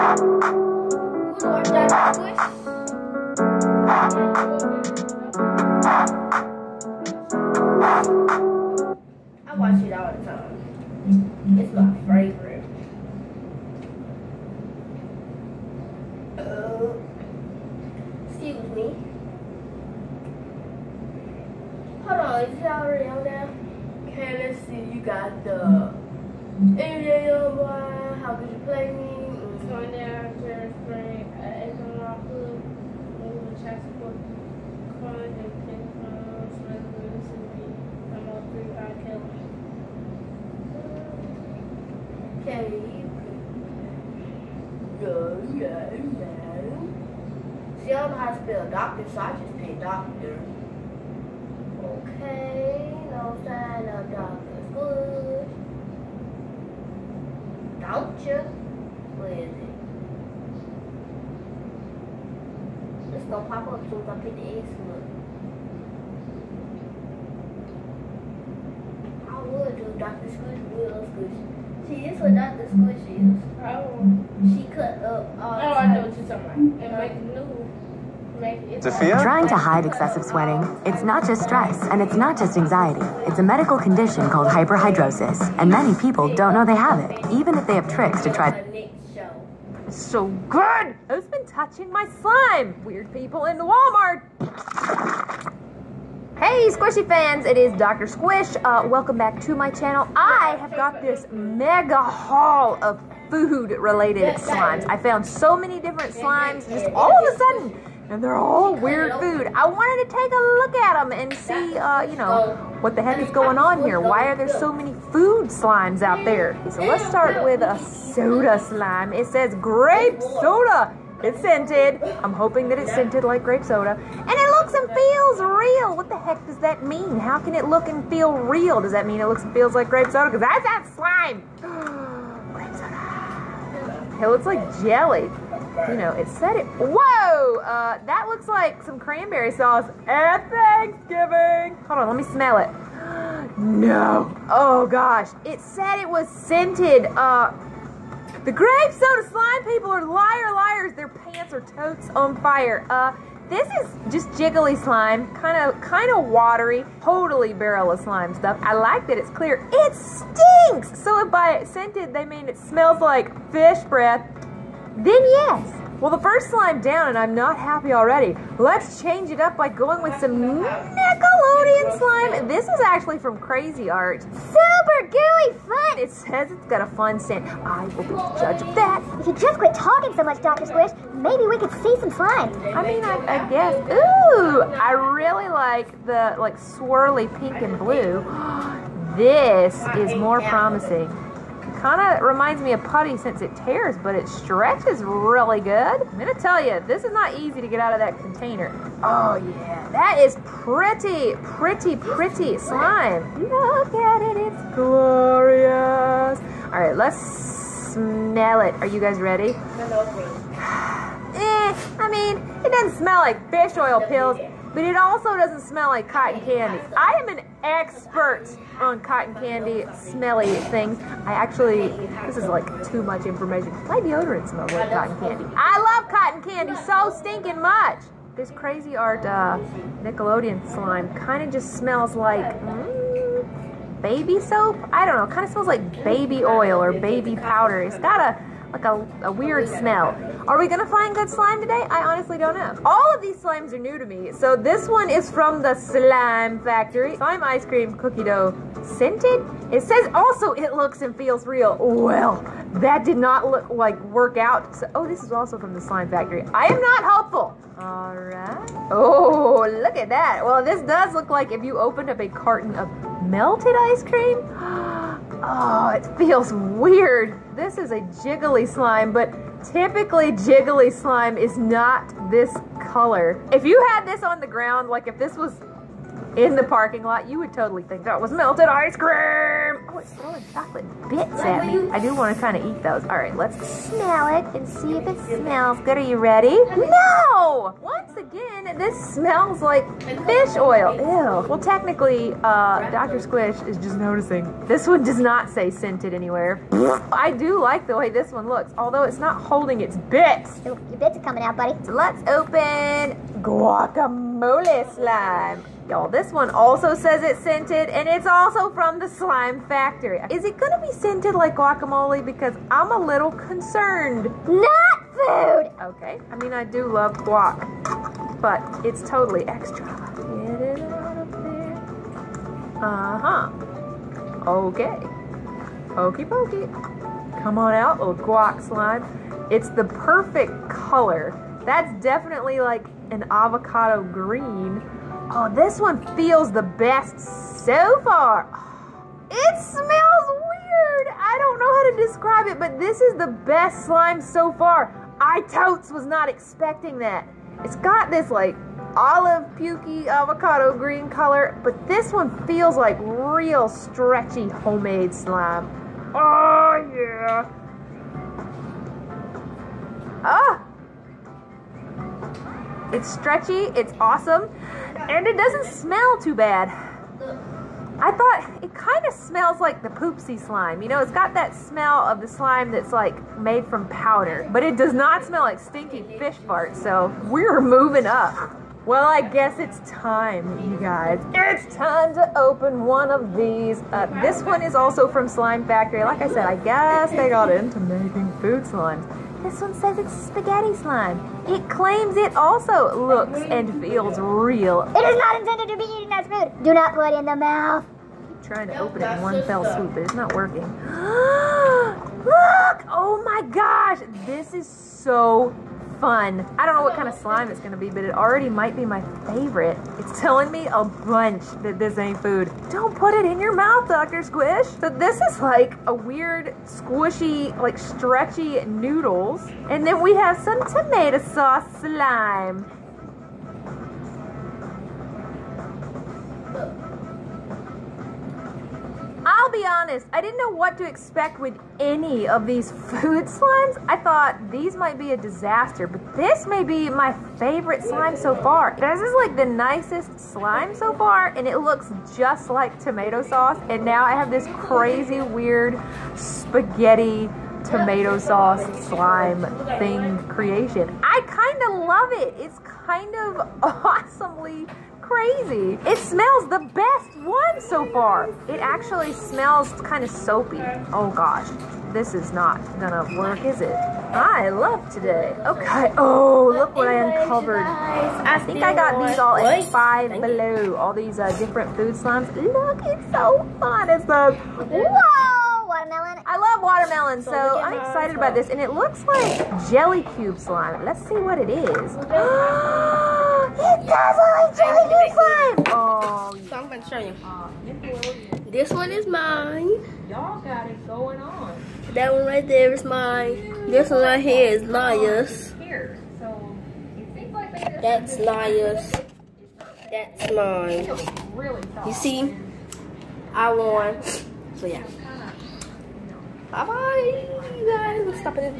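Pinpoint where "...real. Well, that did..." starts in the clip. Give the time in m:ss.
4:11.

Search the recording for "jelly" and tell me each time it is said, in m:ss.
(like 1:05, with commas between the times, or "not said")
2:14, 7:59.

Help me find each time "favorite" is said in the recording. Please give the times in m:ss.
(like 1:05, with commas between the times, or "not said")
6:49, 7:17.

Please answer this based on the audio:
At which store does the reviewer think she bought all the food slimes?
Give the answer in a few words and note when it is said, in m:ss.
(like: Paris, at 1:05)
Five Below, at 7:49.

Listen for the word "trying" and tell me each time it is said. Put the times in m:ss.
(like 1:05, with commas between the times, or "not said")
1:19, 6:38.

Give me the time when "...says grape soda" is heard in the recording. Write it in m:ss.
1:59.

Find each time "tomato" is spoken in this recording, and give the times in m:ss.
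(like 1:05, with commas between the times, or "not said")
7:00, 7:22, 7:27.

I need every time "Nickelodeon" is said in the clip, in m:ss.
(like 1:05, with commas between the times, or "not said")
2:50, 3:50.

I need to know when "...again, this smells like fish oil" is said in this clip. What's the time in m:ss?
4:48.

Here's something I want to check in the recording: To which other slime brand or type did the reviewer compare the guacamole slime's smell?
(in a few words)
Poopsie slime.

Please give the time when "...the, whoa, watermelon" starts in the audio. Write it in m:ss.
7:54.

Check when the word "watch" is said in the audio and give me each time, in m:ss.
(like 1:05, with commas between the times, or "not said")
0:09.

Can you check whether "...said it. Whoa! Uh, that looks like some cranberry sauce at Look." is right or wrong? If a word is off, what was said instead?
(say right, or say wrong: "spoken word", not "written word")
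wrong: "Thanksgiving", not "Look".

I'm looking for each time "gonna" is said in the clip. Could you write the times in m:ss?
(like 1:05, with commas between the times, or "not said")
1:03, 3:16, 4:00, 5:10, 6:47, 7:42.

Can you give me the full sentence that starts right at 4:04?
So this one is from the Slime Factory.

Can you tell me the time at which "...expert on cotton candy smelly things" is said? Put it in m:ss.
3:37.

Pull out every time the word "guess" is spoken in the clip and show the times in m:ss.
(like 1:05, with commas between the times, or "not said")
3:03, 6:19, 6:26.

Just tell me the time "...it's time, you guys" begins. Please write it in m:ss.
6:19.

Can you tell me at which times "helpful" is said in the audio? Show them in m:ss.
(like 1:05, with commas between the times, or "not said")
4:17.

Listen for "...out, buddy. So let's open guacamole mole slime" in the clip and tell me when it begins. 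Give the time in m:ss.
5:01.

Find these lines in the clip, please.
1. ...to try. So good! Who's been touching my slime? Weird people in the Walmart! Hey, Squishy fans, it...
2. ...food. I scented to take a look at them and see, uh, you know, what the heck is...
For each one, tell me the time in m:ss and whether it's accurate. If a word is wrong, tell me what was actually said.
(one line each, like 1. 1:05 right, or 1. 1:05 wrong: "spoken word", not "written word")
1. 1:28 right
2. 1:49 wrong: "wanted", not "scented".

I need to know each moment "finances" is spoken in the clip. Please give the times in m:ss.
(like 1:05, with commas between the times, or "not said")
not said.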